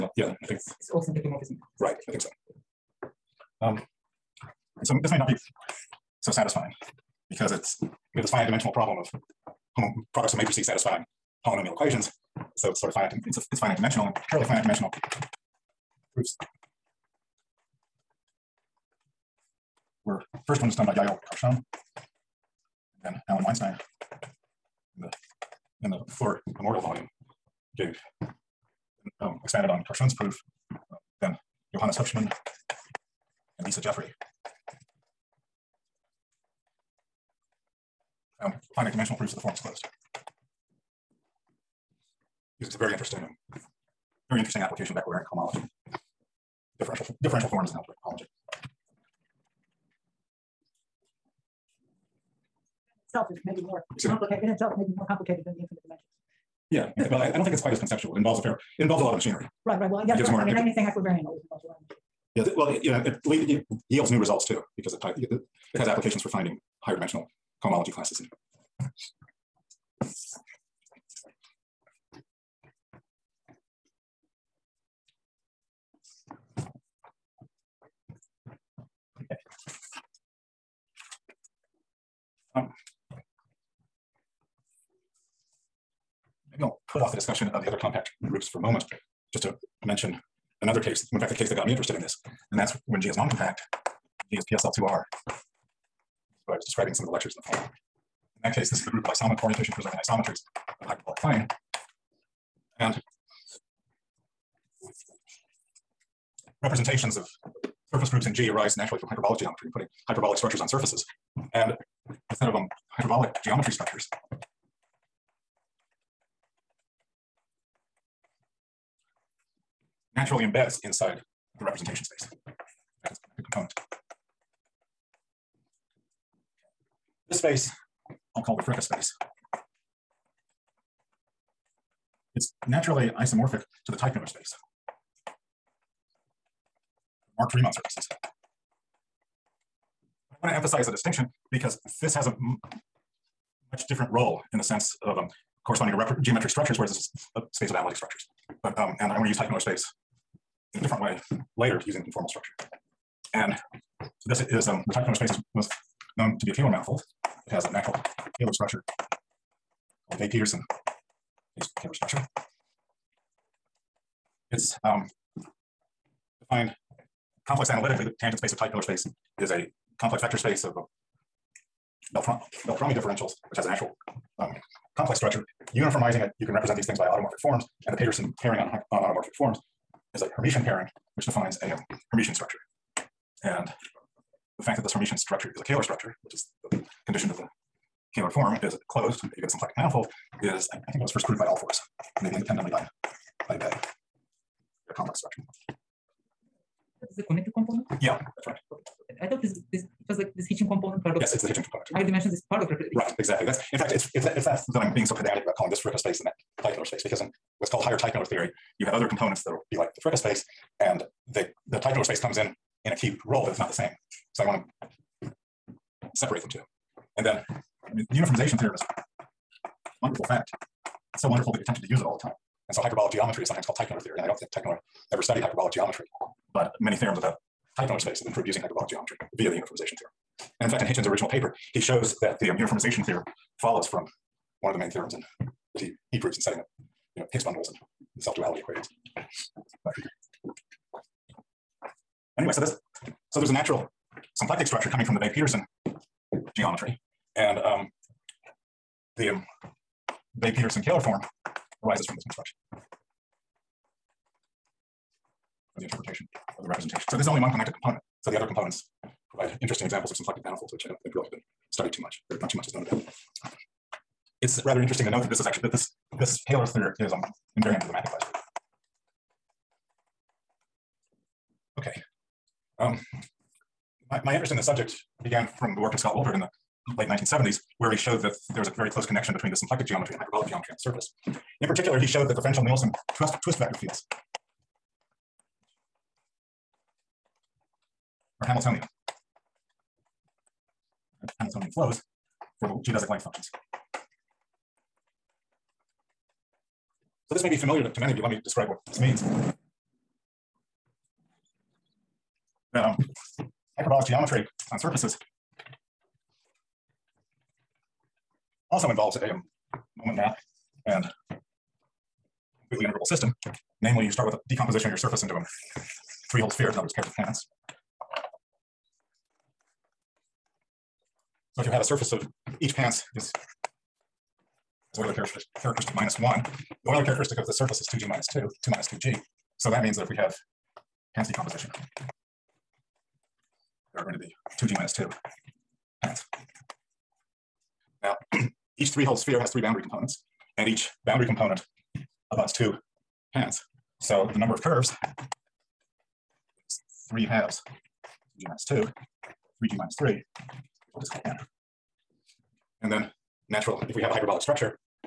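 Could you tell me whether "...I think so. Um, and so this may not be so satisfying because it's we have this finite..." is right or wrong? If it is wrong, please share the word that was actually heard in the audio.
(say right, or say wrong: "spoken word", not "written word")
right.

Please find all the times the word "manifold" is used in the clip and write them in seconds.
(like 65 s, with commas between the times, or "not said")
156 s, 189 s, 260 s.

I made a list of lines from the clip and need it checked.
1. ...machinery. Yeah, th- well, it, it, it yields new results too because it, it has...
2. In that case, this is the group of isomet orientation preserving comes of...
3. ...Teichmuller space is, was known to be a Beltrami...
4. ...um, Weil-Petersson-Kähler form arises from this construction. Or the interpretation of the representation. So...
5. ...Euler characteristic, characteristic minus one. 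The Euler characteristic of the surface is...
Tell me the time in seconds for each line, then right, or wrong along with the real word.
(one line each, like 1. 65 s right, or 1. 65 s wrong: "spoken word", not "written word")
1. 61 s right
2. 98 s wrong: "isometries", not "comes"
3. 154 s wrong: "Kähler", not "Beltrami"
4. 249 s right
5. 324 s right.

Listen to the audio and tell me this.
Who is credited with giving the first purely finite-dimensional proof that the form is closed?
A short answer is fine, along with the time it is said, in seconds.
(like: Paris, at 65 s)
Yael Karshon, at 20 s.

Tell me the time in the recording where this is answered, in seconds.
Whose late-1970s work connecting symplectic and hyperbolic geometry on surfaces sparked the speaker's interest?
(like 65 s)
275 s.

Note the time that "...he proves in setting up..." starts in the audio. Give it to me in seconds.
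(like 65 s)
236 s.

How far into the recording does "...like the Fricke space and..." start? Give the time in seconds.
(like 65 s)
209 s.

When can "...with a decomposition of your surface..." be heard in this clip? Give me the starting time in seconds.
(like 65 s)
314 s.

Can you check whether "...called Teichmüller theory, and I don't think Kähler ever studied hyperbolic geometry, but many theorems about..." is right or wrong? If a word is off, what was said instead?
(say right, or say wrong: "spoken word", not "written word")
wrong: "Teichmüller", not "Kähler".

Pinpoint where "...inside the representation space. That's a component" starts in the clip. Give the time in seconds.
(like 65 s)
120 s.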